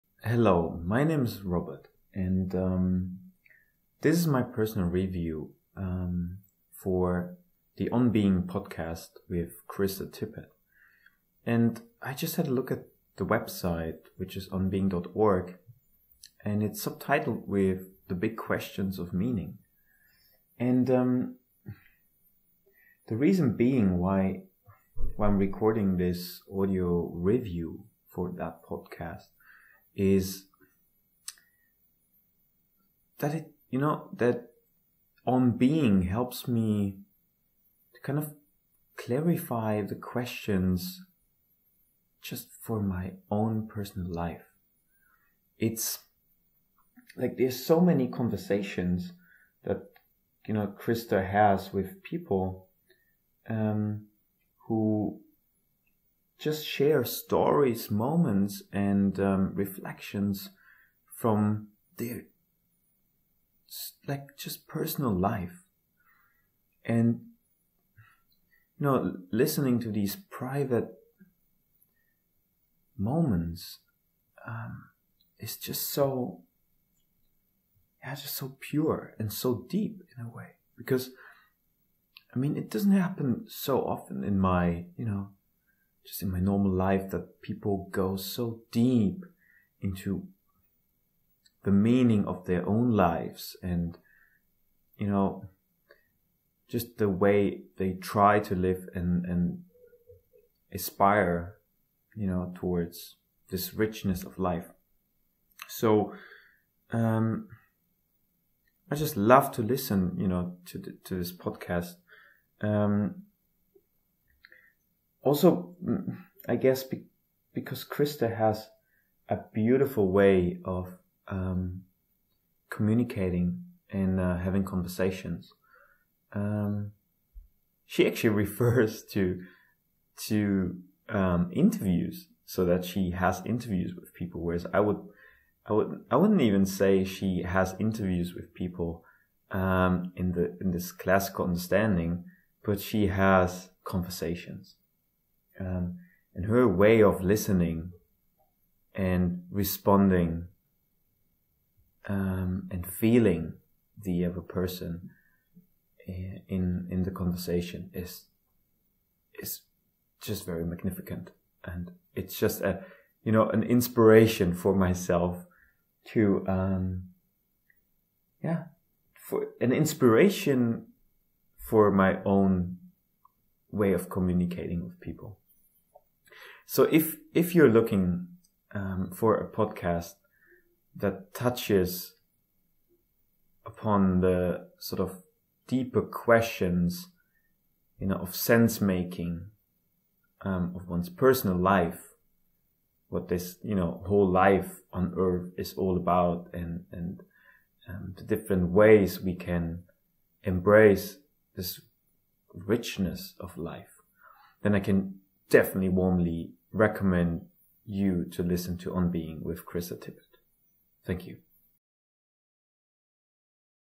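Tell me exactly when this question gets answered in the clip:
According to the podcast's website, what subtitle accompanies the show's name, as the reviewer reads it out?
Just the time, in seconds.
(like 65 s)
18 s.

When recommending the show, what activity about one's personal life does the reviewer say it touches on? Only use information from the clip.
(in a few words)
Sense making.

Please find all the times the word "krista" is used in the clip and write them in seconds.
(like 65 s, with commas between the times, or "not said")
9 s, 50 s, 117 s, 209 s.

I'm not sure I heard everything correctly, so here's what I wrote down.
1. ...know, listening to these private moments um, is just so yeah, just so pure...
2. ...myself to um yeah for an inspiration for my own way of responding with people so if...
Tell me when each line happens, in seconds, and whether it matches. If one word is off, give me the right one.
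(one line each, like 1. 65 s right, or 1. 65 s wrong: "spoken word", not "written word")
1. 68 s right
2. 164 s wrong: "communicating", not "responding".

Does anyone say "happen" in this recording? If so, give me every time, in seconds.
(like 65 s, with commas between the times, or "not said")
82 s.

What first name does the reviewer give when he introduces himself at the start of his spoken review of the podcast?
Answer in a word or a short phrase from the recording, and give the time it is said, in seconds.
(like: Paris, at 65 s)
Robert, at 1 s.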